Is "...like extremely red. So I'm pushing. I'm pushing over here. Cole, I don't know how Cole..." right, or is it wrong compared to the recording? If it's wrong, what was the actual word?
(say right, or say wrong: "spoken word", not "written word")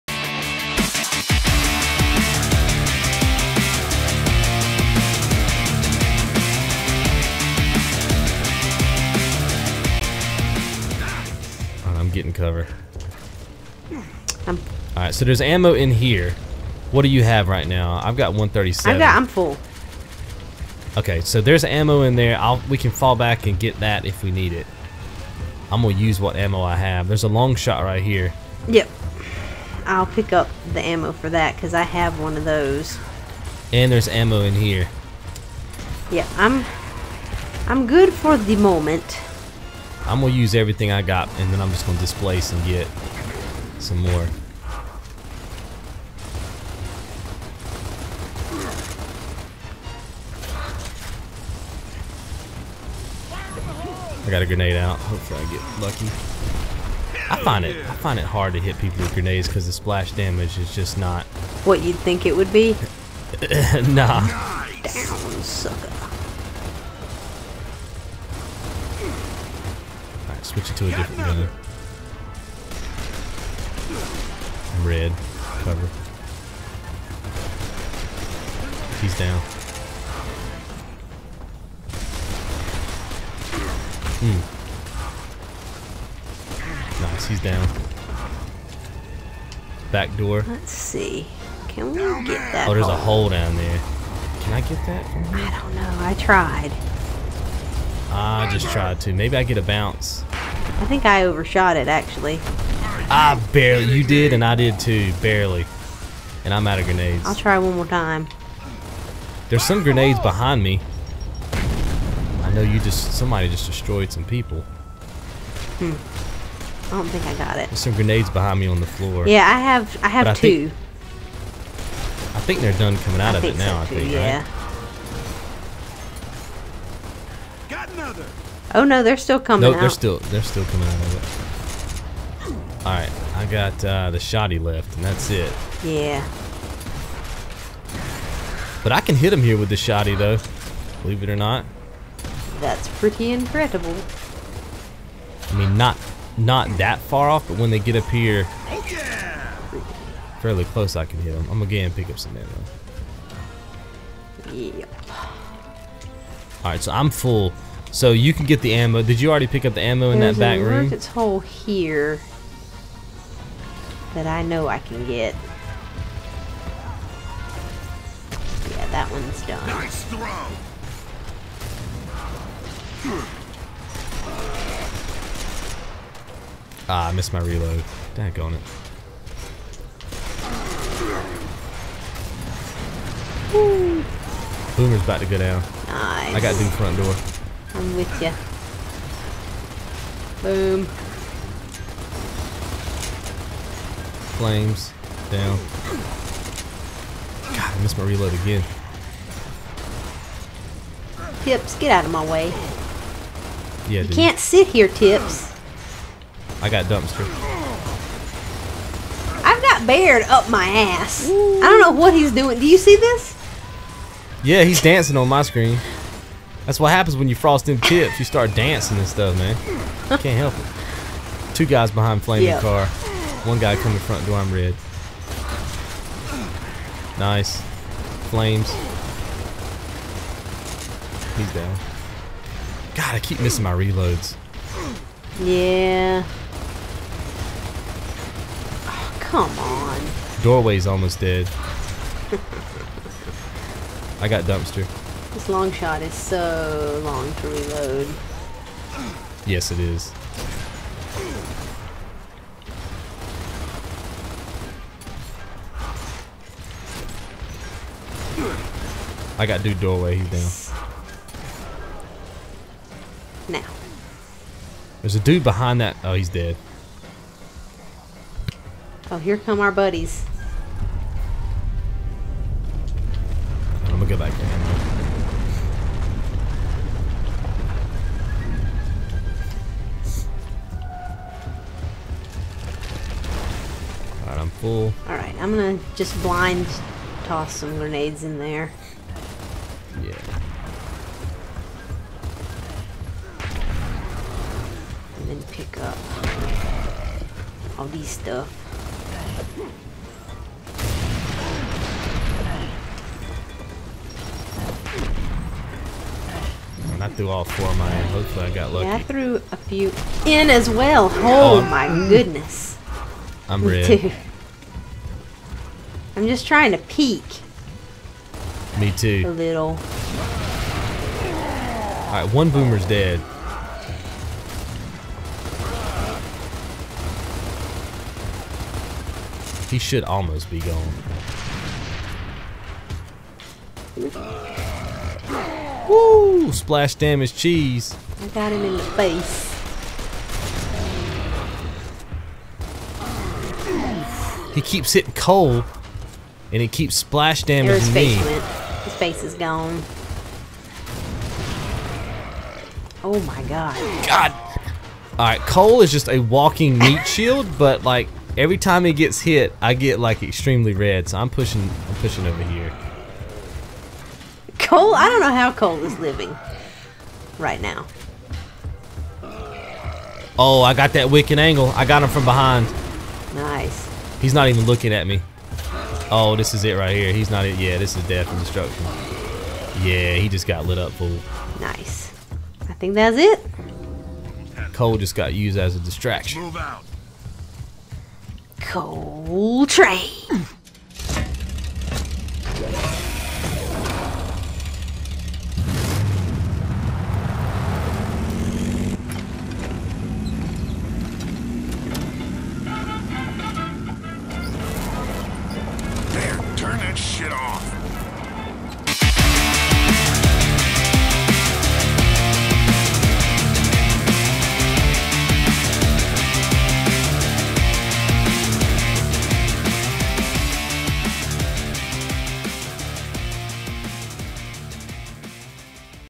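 right.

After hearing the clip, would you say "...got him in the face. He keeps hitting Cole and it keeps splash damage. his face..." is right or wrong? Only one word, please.
right.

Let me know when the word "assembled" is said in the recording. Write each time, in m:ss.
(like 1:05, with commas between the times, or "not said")
not said.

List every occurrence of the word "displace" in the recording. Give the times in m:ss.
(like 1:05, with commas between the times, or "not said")
0:41.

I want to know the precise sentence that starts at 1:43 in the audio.
I barely, you did and I did too, barely.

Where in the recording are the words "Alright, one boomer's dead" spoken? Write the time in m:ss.
5:22.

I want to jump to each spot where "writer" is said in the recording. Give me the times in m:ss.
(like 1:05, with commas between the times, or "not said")
not said.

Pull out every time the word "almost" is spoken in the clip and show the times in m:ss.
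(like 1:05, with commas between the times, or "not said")
4:00, 5:30.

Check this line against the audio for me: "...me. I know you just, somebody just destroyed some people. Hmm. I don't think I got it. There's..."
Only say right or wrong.
right.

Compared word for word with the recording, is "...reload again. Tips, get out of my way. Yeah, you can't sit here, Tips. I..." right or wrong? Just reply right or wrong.
right.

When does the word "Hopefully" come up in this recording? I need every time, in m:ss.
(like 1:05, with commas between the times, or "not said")
0:54, 5:08.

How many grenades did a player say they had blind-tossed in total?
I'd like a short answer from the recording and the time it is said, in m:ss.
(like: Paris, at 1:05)
4, at 5:07.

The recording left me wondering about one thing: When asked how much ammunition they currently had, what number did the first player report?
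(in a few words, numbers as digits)
137.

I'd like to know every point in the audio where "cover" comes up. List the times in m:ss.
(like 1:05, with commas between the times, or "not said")
0:12, 1:15.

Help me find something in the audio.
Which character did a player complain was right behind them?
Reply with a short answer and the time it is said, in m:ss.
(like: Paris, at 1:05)
Baird, at 3:29.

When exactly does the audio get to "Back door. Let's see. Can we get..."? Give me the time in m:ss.
1:29.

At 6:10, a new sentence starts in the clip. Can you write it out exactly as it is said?
Oh, I got that wicked angle.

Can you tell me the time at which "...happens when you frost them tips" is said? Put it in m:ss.
3:36.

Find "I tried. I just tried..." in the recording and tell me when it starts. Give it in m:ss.
1:36.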